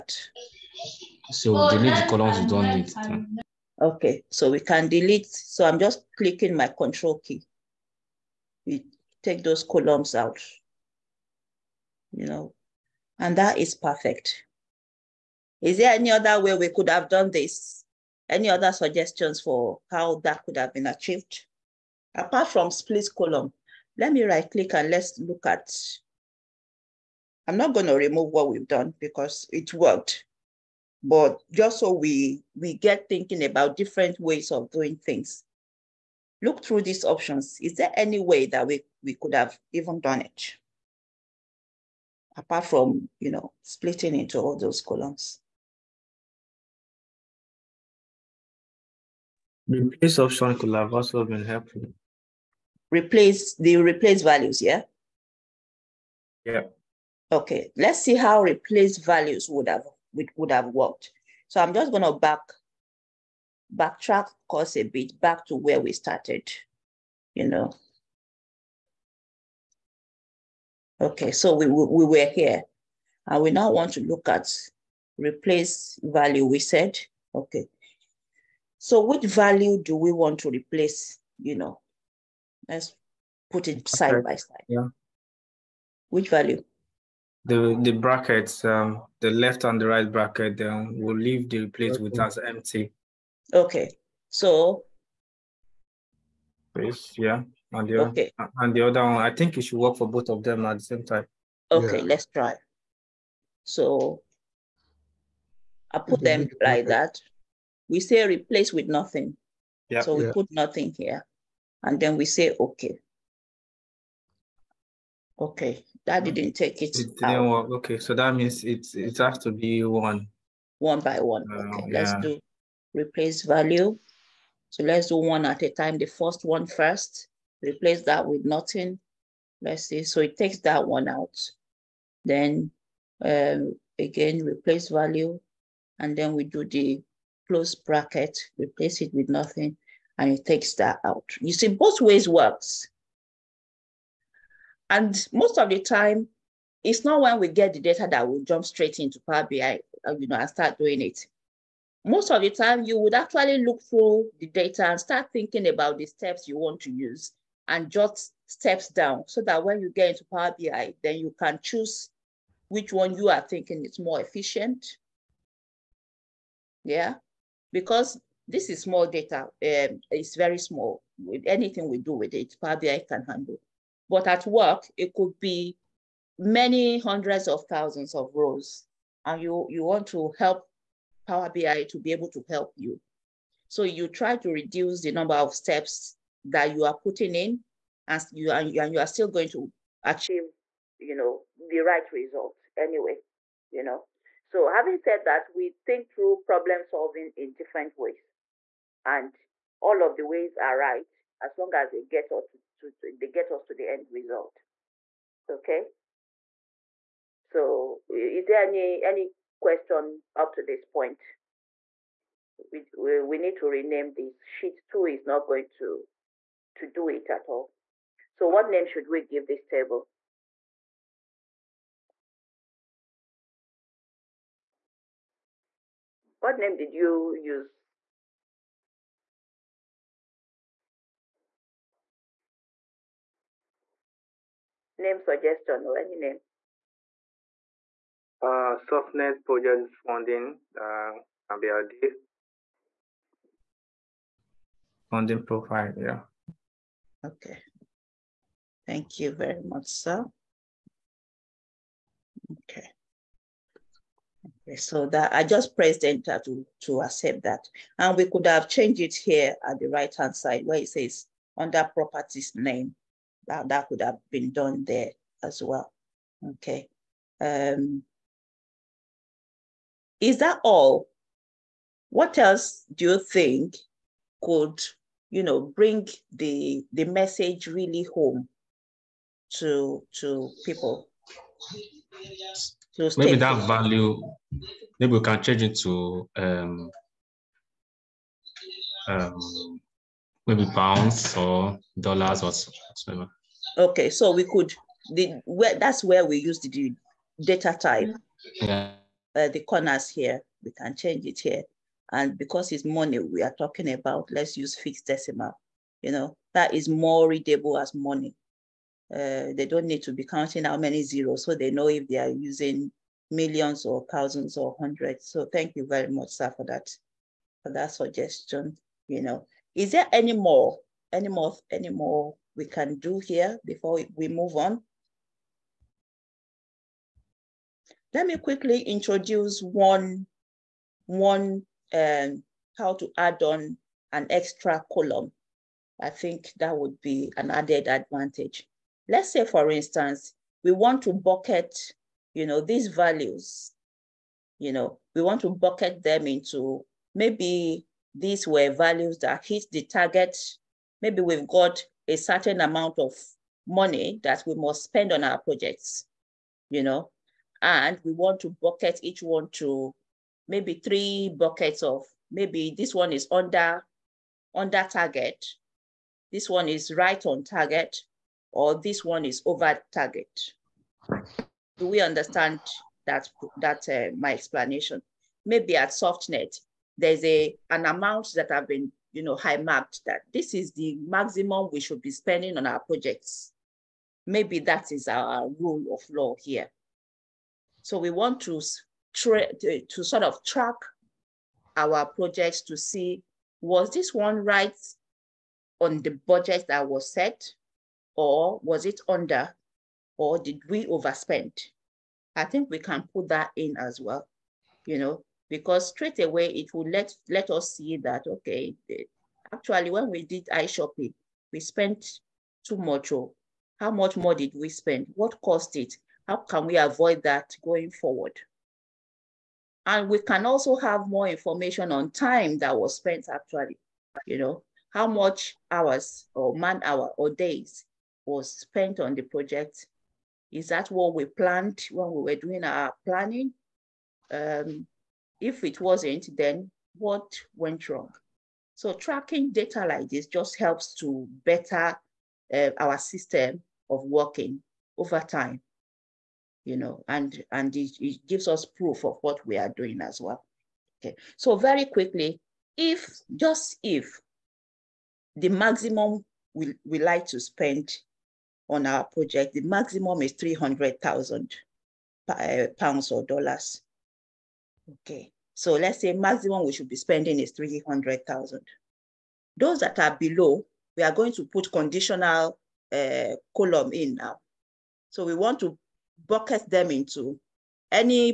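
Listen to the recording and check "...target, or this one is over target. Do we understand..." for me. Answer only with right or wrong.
right.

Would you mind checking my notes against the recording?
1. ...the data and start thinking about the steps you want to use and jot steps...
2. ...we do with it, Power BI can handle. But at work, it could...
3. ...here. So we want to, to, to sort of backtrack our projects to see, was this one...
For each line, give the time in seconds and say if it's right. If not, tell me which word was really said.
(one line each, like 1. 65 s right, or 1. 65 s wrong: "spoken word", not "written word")
1. 154 s right
2. 171 s right
3. 386 s wrong: "track", not "backtrack".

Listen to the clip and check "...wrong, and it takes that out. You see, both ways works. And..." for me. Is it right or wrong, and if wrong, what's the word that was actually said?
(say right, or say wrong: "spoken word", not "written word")
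wrong: "nothing", not "wrong".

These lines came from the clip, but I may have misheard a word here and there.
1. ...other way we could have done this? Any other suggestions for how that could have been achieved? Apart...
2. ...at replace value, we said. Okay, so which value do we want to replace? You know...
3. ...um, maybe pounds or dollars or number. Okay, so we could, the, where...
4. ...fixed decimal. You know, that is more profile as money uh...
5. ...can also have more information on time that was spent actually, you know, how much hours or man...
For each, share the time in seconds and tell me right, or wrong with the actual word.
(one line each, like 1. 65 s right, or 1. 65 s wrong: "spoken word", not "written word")
1. 16 s right
2. 74 s right
3. 289 s wrong: "whatever", not "number"
4. 304 s wrong: "readable", not "profile"
5. 420 s right.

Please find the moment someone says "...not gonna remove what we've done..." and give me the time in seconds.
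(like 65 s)
27 s.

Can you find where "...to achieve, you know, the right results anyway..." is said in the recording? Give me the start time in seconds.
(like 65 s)
189 s.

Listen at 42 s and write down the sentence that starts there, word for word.
Apart from, you know, splitting into all those columns.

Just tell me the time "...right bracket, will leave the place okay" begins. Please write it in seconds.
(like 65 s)
89 s.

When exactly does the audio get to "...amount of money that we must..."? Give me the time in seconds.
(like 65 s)
352 s.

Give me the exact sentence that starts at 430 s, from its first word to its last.
Is that what we planned when we were doing our planning?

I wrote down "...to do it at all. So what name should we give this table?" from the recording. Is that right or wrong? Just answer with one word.
right.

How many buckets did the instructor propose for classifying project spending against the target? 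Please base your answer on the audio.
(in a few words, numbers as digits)
3.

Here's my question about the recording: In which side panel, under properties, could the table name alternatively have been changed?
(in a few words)
Right hand side.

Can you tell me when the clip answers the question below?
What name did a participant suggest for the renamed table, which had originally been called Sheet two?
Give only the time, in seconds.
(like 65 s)
238 s.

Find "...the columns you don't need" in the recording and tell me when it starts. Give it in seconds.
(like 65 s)
1 s.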